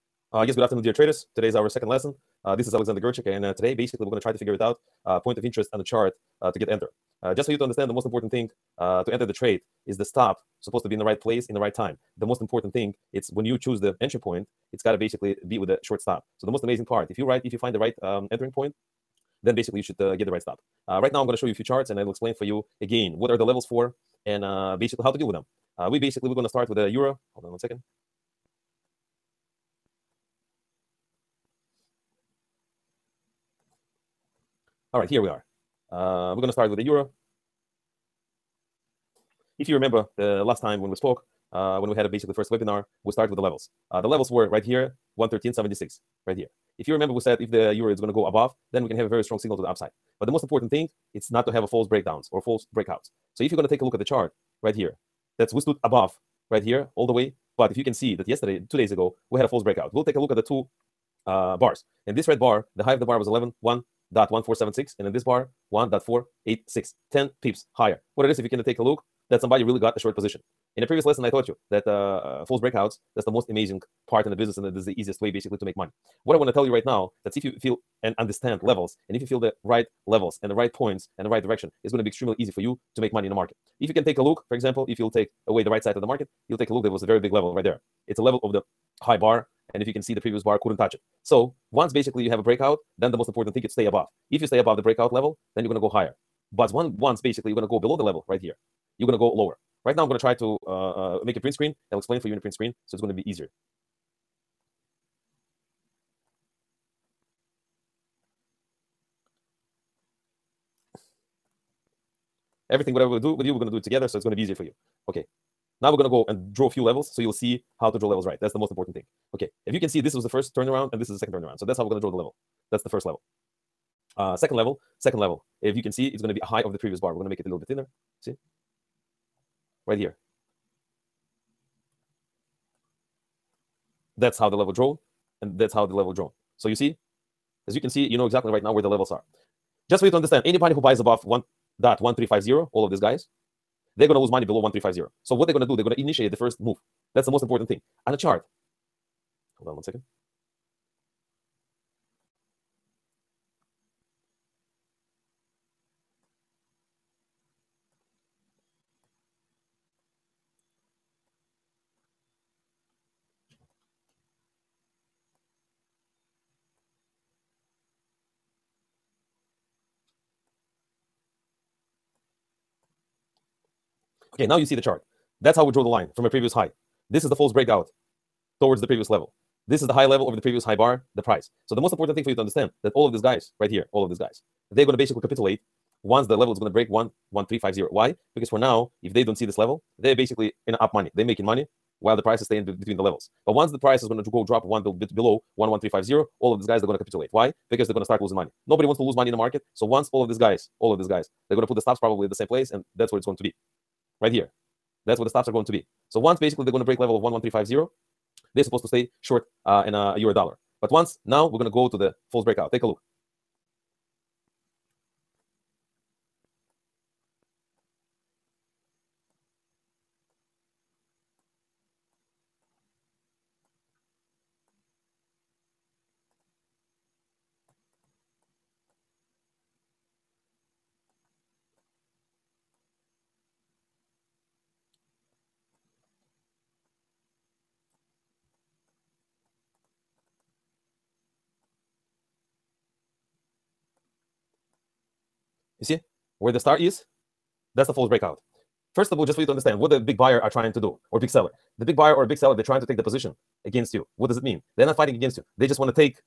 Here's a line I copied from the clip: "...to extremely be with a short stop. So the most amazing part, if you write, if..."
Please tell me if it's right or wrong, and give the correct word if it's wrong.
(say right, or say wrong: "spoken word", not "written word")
wrong: "basically", not "extremely".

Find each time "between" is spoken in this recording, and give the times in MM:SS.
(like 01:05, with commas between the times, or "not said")
03:12.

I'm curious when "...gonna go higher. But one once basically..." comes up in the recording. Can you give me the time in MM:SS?
01:35.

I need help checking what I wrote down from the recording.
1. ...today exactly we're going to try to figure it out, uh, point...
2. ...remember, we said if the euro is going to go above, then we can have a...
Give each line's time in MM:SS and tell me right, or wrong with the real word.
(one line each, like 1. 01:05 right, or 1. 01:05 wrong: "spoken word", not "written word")
1. 00:03 wrong: "basically", not "exactly"
2. 00:46 right.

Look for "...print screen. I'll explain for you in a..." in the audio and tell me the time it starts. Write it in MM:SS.
01:41.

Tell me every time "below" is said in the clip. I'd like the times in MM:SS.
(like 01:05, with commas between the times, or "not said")
01:37, 02:24, 03:15.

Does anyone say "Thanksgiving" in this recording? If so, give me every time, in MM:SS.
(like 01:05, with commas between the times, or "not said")
not said.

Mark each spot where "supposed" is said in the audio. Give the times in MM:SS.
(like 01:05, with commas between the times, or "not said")
00:10, 03:28.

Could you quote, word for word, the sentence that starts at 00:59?
We'll take a look at the two uh, bars.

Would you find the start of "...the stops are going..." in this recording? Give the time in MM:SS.
03:25.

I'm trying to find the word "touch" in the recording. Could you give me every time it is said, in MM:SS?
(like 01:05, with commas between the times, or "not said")
01:30.